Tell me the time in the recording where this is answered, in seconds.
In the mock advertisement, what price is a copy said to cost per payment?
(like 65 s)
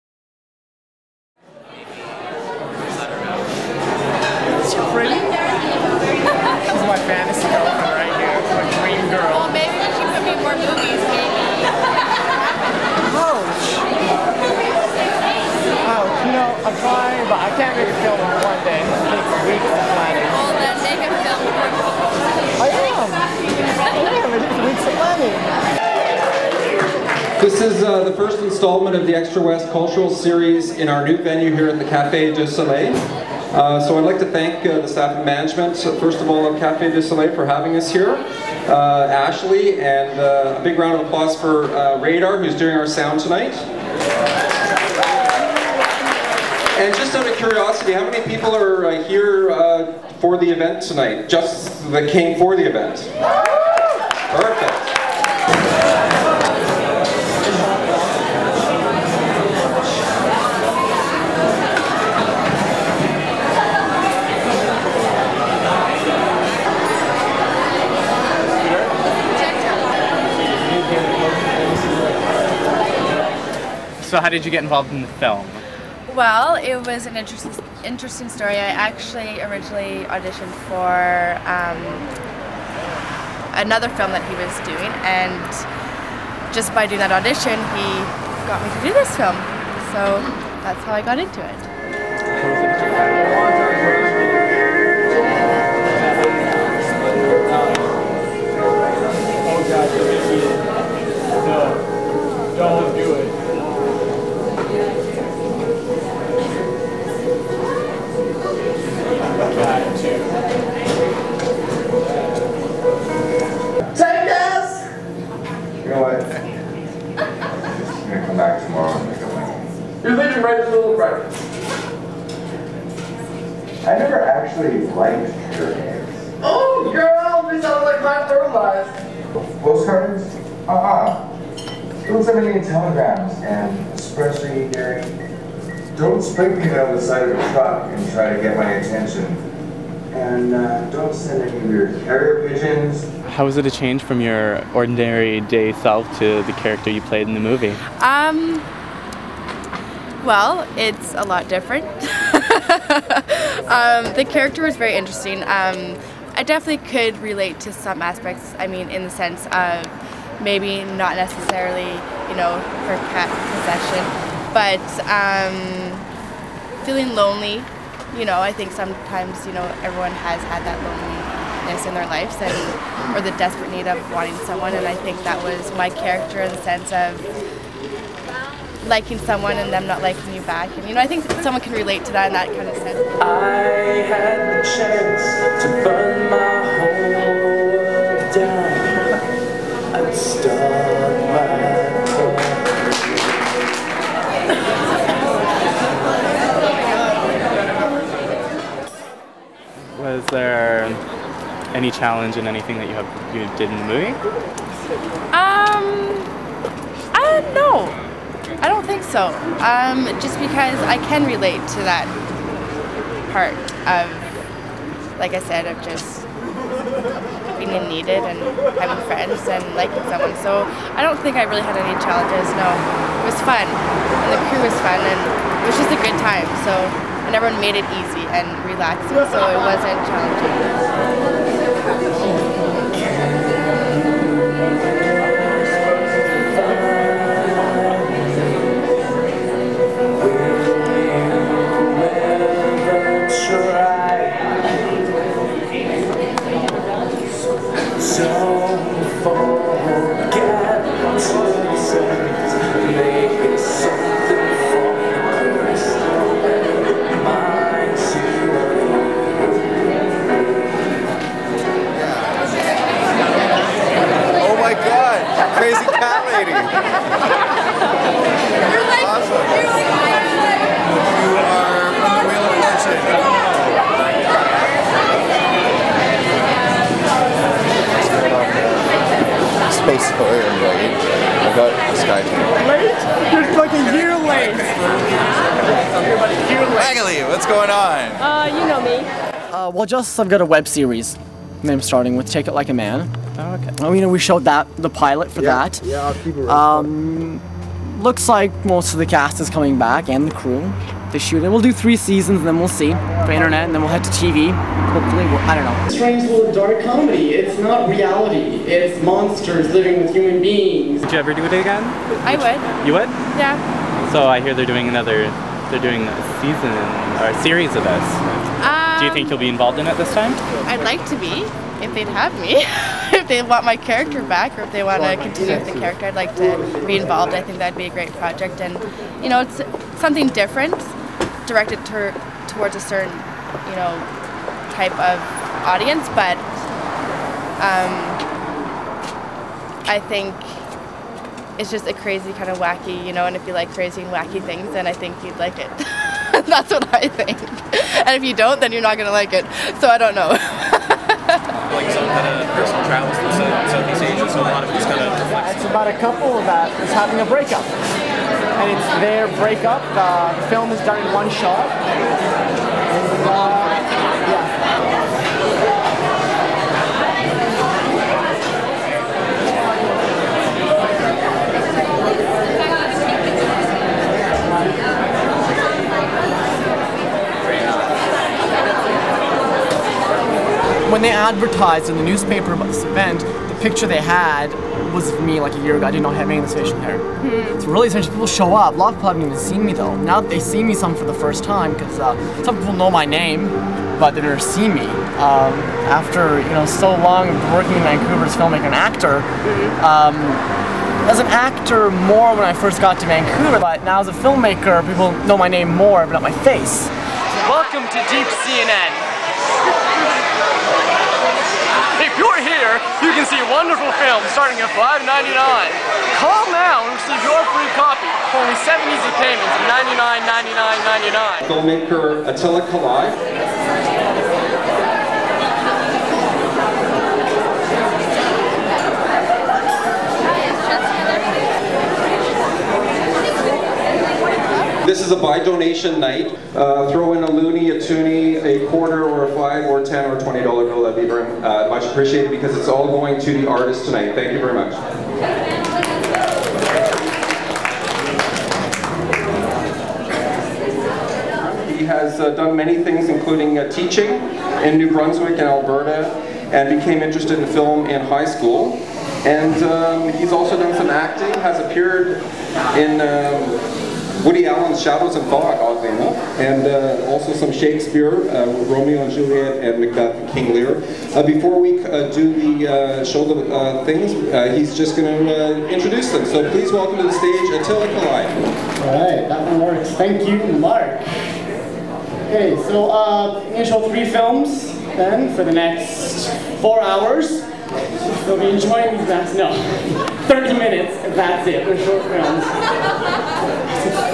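421 s.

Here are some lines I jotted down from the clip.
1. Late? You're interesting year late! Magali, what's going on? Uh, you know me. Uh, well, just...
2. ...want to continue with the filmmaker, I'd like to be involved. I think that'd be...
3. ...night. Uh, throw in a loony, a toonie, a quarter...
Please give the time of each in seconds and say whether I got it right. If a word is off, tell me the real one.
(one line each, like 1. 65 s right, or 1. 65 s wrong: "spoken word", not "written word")
1. 282 s wrong: "fucking", not "interesting"
2. 324 s wrong: "character", not "filmmaker"
3. 435 s right.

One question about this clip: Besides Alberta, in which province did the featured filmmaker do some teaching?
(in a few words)
New Brunswick.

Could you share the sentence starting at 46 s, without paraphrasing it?
And just out of curiosity, how many people are here for the event tonight?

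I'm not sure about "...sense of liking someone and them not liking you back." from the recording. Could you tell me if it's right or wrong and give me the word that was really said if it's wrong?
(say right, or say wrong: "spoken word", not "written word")
right.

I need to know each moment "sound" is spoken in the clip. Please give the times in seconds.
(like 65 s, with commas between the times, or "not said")
42 s, 127 s.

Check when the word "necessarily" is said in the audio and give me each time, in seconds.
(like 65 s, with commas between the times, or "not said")
161 s.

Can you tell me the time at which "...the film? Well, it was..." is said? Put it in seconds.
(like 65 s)
75 s.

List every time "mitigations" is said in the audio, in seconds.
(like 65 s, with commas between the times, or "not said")
not said.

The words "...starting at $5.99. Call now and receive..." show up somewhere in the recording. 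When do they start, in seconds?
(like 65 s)
414 s.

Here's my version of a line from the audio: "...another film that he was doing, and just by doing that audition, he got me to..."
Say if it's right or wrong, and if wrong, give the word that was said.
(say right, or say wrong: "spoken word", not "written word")
right.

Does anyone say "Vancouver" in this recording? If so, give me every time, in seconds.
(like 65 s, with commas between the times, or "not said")
397 s, 403 s.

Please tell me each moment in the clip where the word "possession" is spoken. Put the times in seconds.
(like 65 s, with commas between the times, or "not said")
163 s.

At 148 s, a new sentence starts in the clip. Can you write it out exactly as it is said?
Um, well, it's a lot different.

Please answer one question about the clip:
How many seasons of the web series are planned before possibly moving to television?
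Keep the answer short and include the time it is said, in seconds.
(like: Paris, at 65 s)
3, at 301 s.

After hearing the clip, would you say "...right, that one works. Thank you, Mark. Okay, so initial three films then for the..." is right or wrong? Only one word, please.
right.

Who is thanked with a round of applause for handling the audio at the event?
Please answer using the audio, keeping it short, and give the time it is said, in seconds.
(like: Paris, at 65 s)
Radar, at 42 s.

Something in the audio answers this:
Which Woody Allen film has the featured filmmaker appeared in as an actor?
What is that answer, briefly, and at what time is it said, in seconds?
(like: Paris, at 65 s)
Shadows and Fog, at 464 s.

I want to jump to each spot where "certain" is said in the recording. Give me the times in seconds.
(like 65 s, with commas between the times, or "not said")
332 s.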